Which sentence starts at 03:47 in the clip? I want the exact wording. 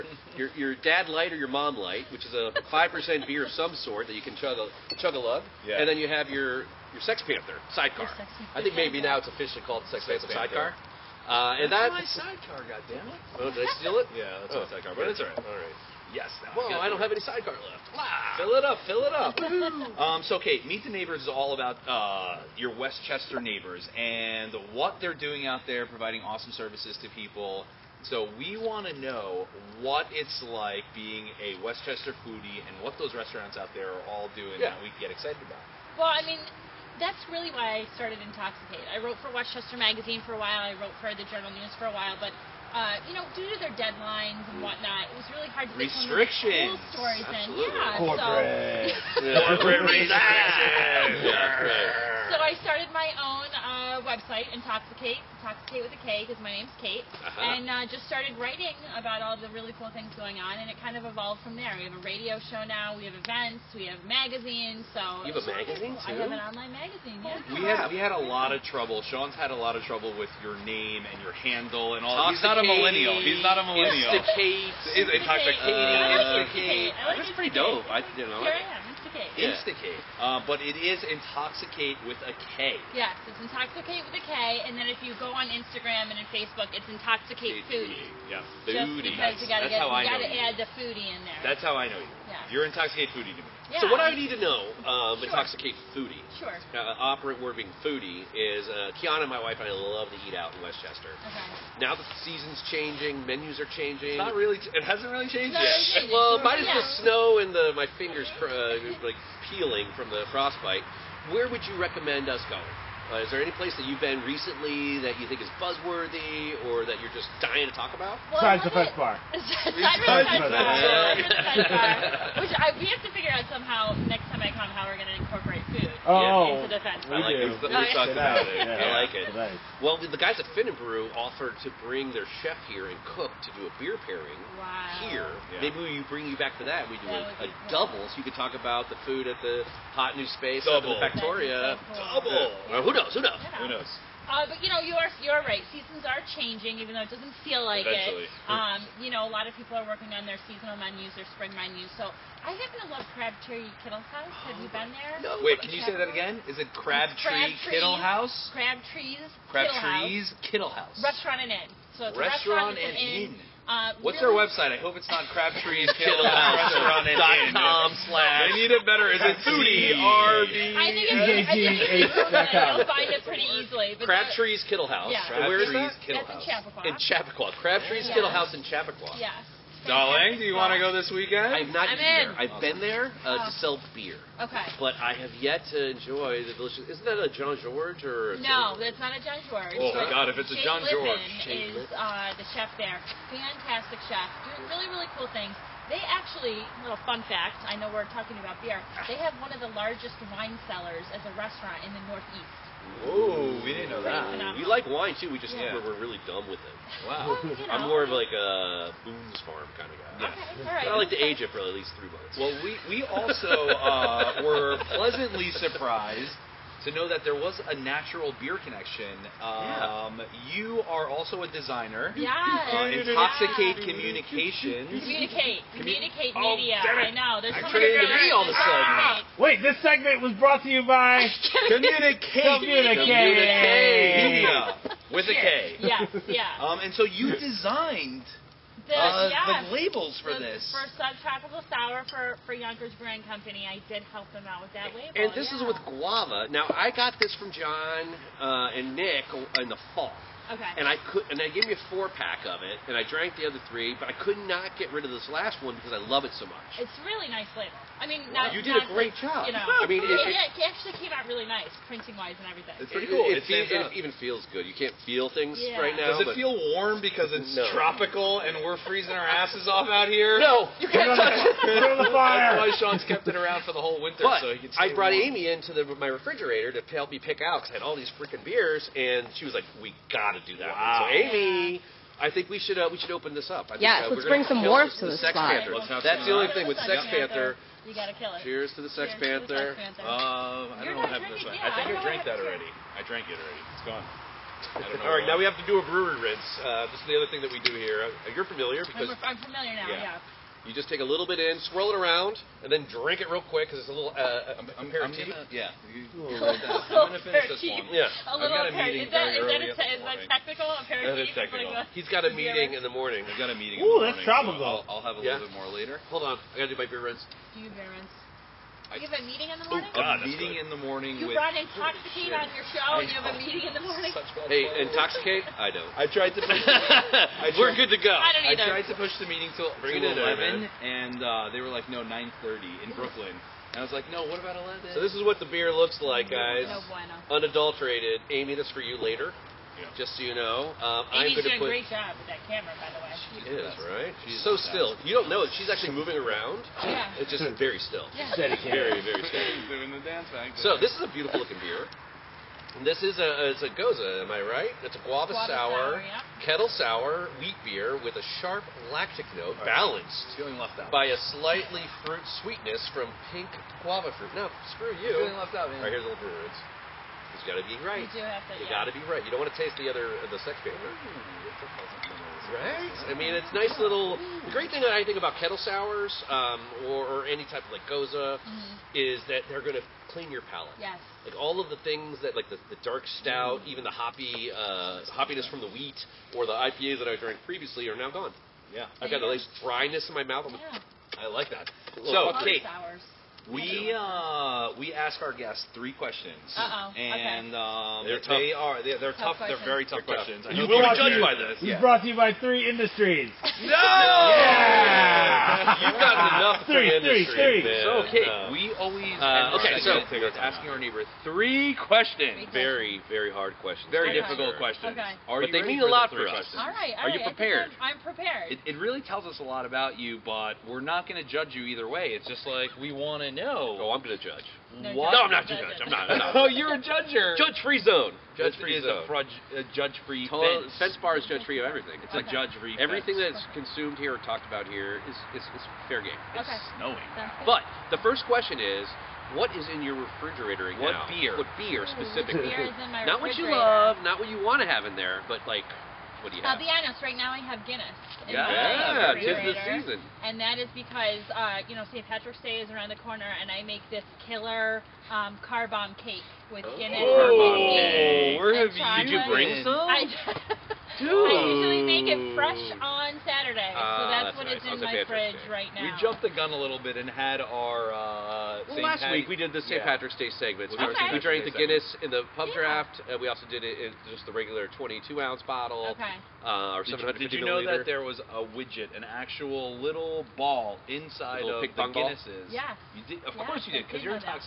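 There's I so trained all of a sudden.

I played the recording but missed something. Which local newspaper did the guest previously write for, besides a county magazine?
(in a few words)
the Journal News.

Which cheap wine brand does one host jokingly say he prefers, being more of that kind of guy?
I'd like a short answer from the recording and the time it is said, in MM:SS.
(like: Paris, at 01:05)
Boone's Farm, at 03:29.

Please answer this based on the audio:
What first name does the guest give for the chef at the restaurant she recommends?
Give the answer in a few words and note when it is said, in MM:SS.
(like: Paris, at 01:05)
Shane, at 03:11.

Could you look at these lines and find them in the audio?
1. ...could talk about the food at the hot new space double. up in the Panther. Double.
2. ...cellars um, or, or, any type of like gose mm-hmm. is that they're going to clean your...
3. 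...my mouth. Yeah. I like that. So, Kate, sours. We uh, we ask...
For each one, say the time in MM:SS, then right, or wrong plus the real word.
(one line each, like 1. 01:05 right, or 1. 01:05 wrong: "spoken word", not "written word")
1. 02:18 wrong: "Factoria", not "Panther"
2. 06:15 wrong: "sours", not "cellars"
3. 06:30 right.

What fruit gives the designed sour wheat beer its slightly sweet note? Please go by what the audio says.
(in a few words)
pink guava.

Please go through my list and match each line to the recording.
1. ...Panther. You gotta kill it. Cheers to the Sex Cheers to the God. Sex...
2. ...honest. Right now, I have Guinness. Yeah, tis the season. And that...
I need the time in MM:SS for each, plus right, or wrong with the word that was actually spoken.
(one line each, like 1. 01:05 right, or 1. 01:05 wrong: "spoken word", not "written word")
1. 04:47 wrong: "Panther", not "God"
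2. 07:26 right.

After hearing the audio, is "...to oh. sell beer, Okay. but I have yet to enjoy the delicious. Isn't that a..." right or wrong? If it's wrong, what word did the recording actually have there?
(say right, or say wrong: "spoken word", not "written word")
right.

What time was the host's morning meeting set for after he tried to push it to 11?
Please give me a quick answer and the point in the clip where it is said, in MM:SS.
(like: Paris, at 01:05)
9:30, at 05:32.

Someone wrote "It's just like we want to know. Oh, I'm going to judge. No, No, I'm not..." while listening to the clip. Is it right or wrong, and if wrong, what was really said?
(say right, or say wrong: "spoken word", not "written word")
right.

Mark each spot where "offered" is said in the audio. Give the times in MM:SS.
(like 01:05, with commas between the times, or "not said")
02:11.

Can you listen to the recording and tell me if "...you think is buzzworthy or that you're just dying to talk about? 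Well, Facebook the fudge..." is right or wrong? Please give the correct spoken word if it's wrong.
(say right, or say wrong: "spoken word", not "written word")
wrong: "Besides", not "Facebook".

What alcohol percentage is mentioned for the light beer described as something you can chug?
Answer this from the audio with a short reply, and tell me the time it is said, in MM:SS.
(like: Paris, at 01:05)
5 percent, at 00:02.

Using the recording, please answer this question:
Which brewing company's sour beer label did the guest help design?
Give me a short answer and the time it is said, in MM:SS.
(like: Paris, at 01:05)
Yonkers Brewing Company, at 04:02.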